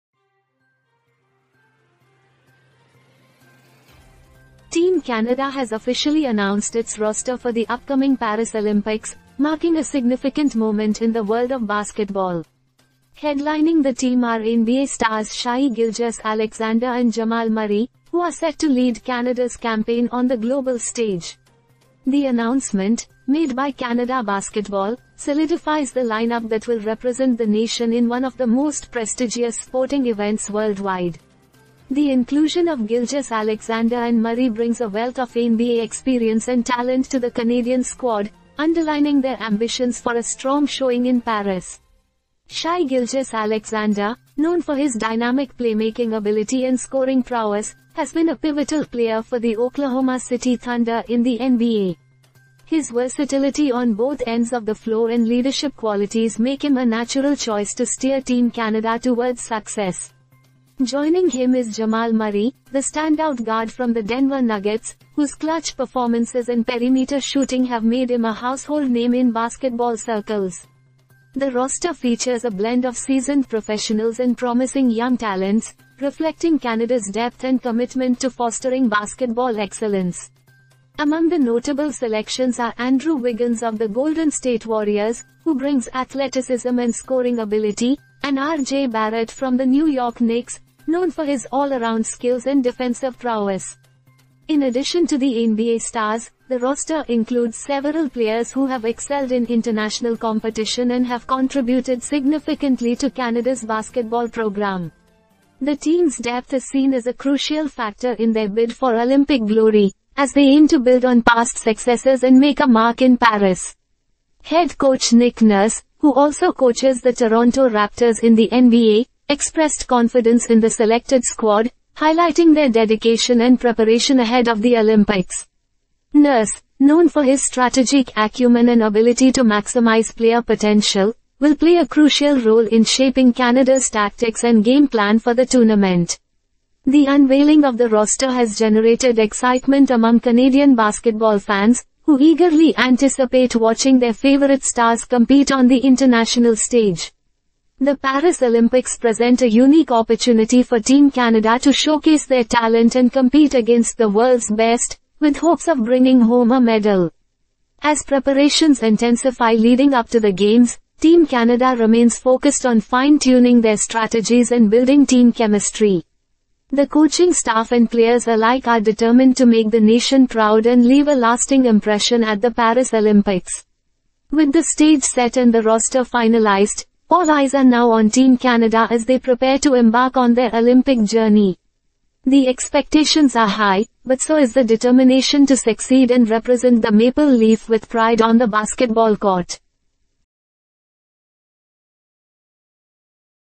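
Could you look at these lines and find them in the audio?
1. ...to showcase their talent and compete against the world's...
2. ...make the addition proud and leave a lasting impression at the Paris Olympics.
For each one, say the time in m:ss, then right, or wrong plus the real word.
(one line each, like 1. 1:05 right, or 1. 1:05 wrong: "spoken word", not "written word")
1. 2:31 right
2. 2:49 wrong: "nation", not "addition".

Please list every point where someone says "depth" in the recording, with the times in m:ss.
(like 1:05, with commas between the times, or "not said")
1:17, 1:46.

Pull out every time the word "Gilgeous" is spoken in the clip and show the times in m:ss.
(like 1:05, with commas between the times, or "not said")
0:15, 0:32, 0:42.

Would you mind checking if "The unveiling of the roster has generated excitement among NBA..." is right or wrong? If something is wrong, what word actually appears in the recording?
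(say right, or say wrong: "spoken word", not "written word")
wrong: "Canadian", not "NBA".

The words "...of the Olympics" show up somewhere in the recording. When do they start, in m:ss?
2:04.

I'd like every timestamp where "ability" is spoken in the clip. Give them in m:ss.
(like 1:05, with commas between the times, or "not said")
0:46, 1:27, 2:08.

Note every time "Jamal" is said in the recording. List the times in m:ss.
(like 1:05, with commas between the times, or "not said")
0:17, 1:01.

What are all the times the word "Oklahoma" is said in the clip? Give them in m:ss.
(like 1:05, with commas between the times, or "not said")
0:49.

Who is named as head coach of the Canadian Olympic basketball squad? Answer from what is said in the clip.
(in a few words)
Nick Nurse.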